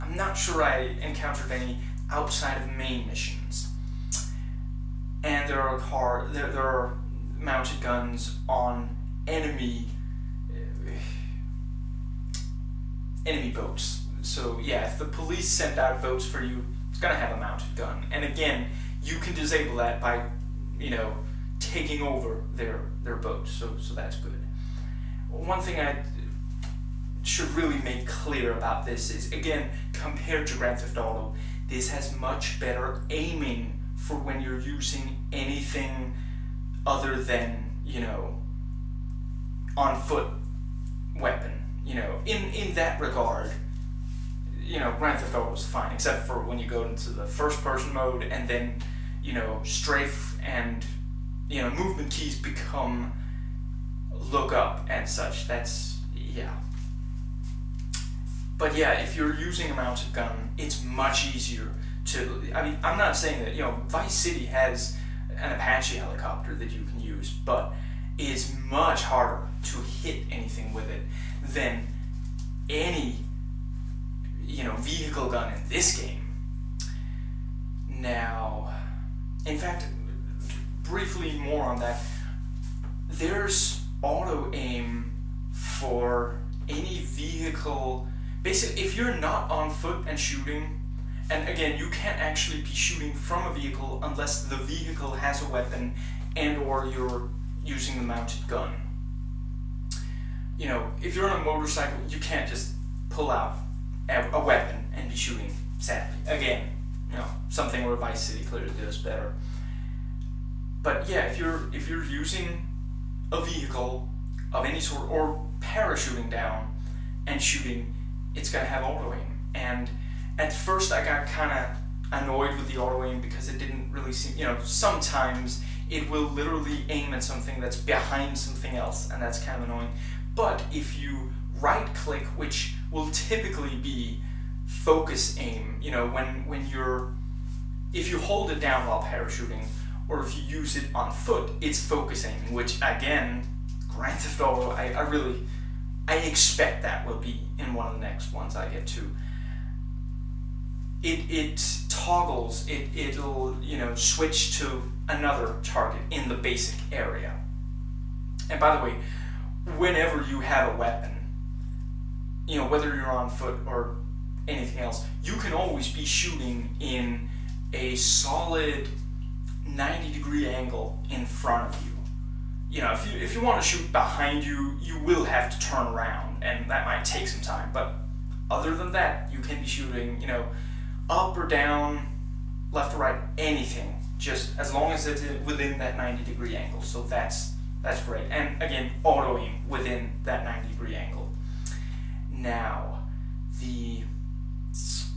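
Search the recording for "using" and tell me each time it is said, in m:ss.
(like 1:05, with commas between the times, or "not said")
0:34, 0:59, 1:37, 1:52.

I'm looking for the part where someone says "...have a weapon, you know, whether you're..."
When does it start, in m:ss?
2:40.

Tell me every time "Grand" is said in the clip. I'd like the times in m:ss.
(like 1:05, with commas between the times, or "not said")
0:30, 0:44, 2:23.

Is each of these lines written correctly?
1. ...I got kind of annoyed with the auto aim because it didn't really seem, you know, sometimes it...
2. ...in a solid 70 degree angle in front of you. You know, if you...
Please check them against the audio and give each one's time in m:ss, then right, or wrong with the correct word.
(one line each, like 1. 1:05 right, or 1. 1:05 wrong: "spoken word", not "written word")
1. 2:00 right
2. 2:46 wrong: "90", not "70".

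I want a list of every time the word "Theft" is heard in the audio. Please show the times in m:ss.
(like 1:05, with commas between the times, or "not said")
0:30, 0:45, 2:24.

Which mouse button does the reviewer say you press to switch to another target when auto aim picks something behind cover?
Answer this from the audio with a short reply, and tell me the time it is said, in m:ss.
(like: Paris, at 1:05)
Right click, at 2:11.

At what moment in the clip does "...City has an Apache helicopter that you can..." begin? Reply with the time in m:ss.
1:04.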